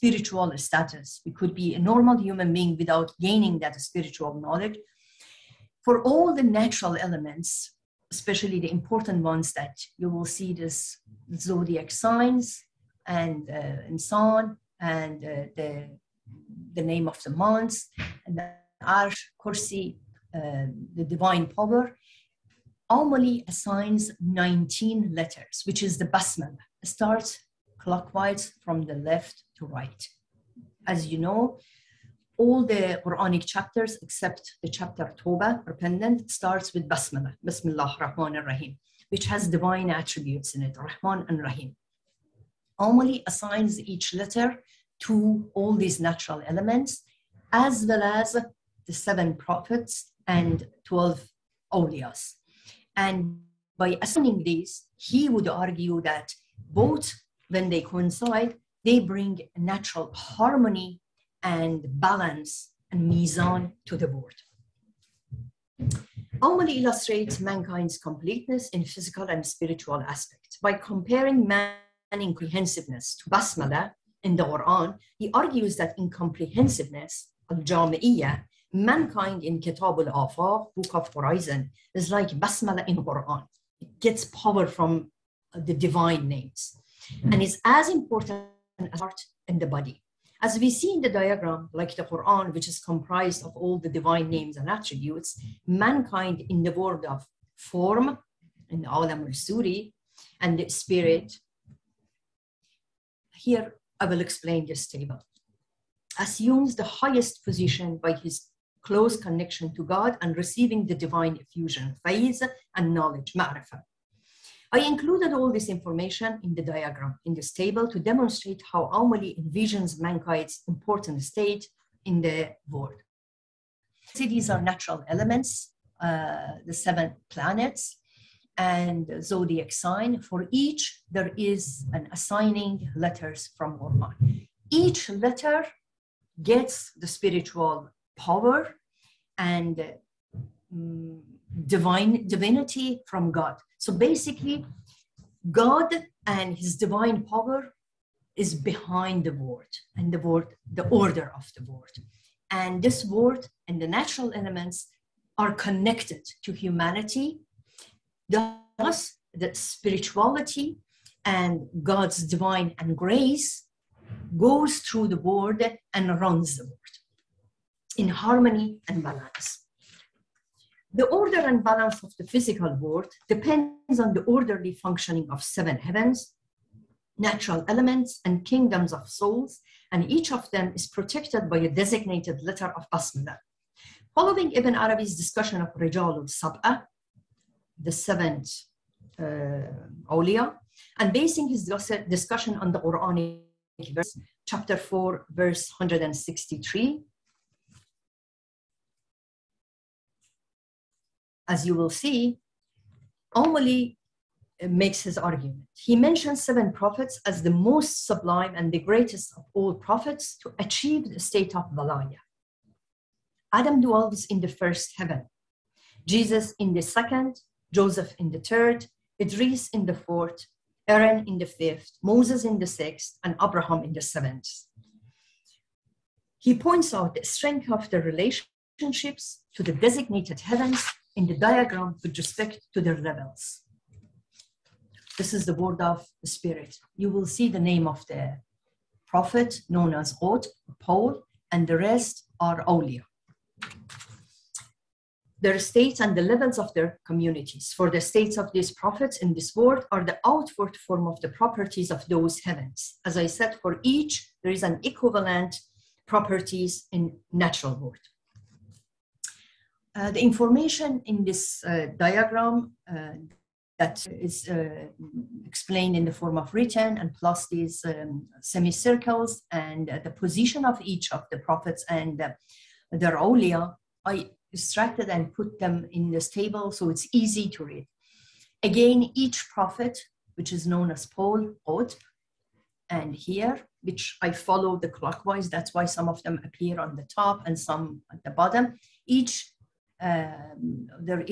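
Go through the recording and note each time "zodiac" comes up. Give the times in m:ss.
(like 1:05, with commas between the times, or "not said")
0:11, 2:09.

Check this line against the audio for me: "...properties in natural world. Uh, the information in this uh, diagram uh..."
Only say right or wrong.
right.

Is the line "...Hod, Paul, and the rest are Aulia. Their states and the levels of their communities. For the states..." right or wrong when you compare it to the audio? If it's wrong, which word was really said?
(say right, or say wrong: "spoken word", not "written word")
right.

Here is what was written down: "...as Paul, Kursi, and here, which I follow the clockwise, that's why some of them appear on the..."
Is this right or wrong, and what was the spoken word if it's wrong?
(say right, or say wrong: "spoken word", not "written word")
wrong: "Otp", not "Kursi".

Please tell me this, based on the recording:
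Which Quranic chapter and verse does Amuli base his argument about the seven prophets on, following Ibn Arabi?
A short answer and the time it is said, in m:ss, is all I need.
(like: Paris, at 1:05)
Chapter 4, verse 163, at 3:14.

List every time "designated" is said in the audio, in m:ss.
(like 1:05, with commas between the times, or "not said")
3:01, 3:49.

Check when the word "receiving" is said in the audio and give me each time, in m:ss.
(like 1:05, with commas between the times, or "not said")
1:50.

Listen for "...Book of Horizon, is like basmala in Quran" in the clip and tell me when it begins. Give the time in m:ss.
1:20.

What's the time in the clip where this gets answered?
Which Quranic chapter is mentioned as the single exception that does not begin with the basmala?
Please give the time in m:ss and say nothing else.
0:35.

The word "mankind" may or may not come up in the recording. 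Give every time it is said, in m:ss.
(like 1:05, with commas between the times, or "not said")
1:07, 1:18, 1:35, 1:59.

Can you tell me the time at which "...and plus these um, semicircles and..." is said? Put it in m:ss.
4:26.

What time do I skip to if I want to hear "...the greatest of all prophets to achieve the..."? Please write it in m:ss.
3:28.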